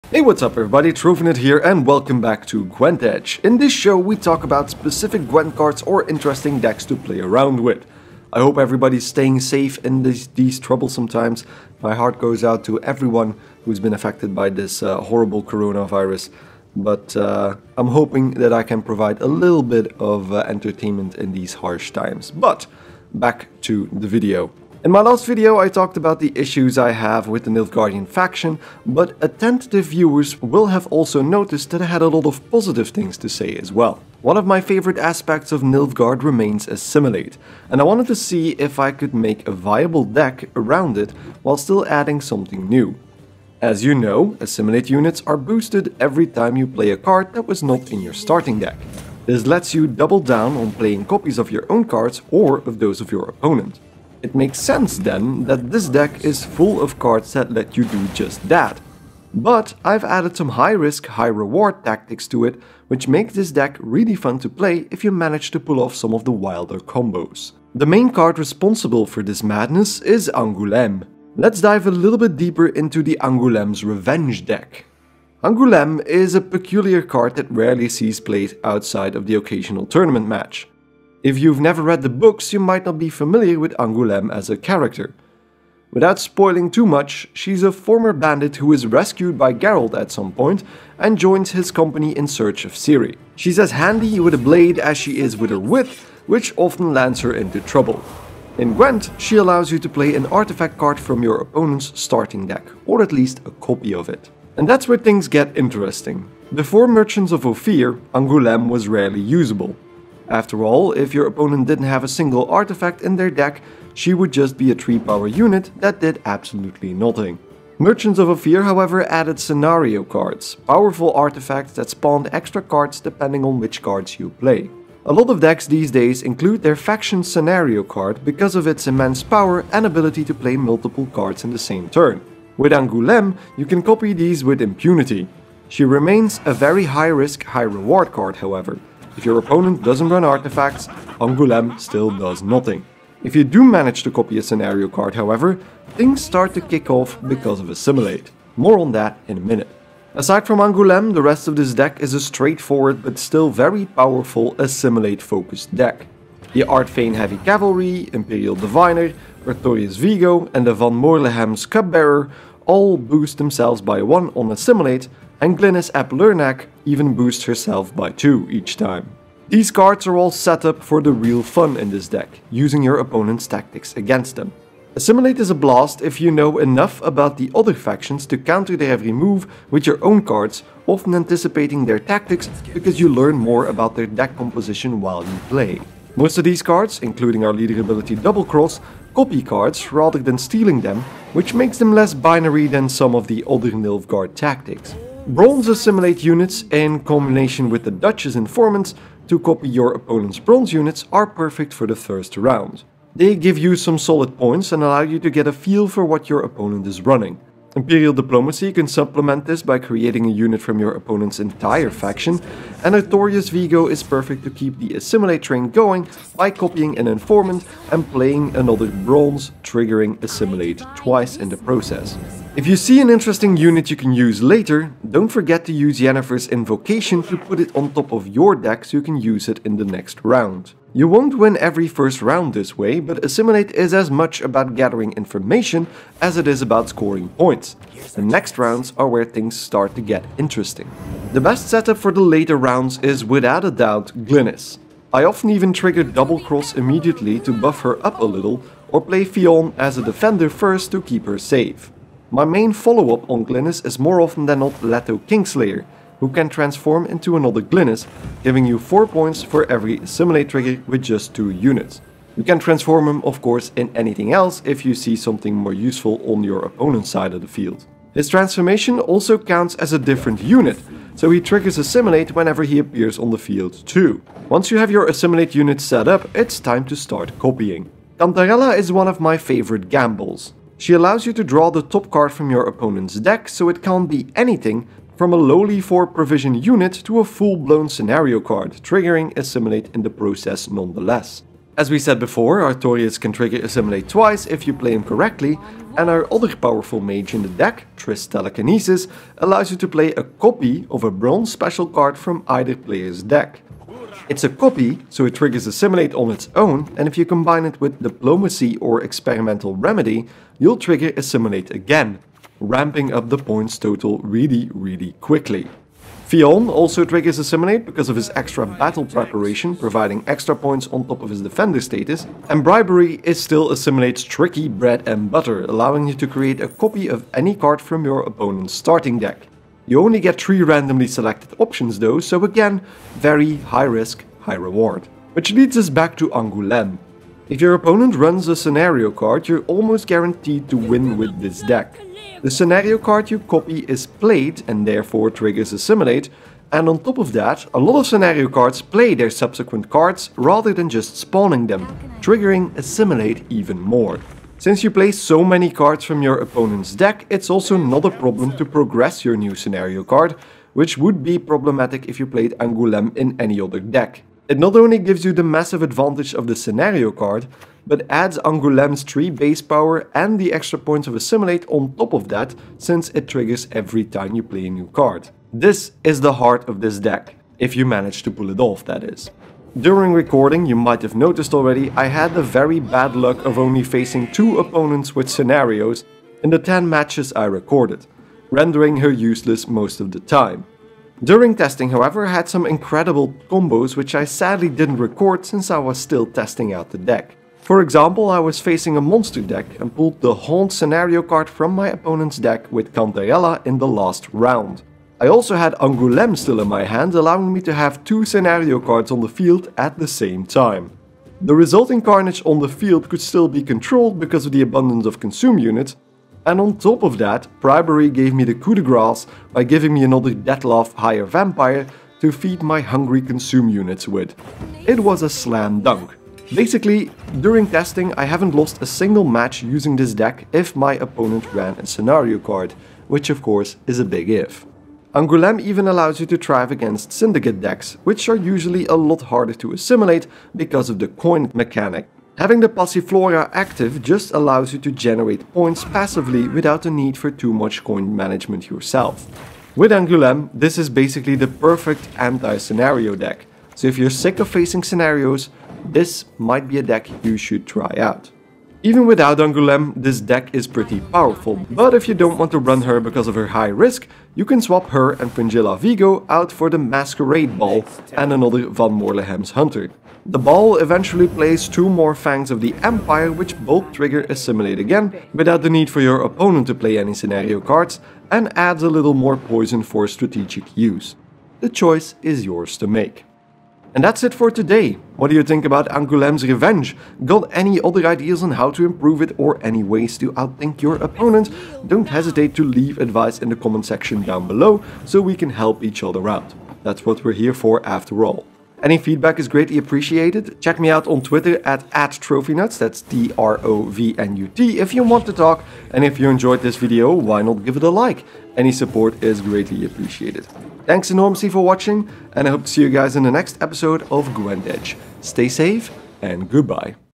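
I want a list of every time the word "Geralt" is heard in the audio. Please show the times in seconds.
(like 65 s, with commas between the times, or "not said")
89 s.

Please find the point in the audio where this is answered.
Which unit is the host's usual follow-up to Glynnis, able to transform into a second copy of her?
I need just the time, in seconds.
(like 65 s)
254 s.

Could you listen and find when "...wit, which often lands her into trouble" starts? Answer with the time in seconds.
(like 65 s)
95 s.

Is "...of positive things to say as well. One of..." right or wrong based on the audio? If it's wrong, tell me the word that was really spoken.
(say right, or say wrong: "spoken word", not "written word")
right.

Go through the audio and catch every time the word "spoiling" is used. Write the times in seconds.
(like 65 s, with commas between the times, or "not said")
86 s.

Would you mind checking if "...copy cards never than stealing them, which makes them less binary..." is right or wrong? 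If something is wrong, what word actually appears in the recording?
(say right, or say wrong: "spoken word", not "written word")
wrong: "rather", not "never".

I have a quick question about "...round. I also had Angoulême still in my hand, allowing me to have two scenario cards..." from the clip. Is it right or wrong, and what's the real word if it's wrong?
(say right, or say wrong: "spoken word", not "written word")
right.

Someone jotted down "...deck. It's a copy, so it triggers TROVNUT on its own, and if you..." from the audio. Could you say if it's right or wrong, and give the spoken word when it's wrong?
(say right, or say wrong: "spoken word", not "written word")
wrong: "Assimilate", not "TROVNUT".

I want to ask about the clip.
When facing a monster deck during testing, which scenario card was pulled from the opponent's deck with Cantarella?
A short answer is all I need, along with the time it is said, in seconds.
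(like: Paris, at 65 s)
Haunt, at 400 s.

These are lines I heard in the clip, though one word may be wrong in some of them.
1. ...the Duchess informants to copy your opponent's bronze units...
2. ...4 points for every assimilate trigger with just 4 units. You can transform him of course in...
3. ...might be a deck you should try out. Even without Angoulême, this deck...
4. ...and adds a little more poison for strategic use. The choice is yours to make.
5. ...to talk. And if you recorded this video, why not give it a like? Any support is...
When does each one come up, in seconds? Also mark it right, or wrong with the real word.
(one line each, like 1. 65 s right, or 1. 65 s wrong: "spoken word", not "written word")
1. 197 s right
2. 258 s wrong: "2", not "4"
3. 456 s right
4. 478 s right
5. 505 s wrong: "enjoyed", not "recorded".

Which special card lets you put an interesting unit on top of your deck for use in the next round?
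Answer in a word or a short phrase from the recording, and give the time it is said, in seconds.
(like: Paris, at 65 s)
Yennefer's Invocation, at 226 s.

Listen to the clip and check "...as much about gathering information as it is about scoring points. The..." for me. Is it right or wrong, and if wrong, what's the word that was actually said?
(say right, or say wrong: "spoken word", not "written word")
right.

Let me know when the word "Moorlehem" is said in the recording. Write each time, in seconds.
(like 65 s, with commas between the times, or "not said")
160 s, 468 s.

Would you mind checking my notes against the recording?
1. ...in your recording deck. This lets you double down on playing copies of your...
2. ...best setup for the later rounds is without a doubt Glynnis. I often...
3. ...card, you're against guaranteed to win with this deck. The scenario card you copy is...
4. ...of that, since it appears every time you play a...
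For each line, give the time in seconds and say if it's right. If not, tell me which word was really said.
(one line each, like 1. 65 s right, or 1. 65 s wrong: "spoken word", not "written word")
1. 47 s wrong: "starting", not "recording"
2. 241 s right
3. 339 s wrong: "almost", not "against"
4. 372 s wrong: "triggers", not "appears".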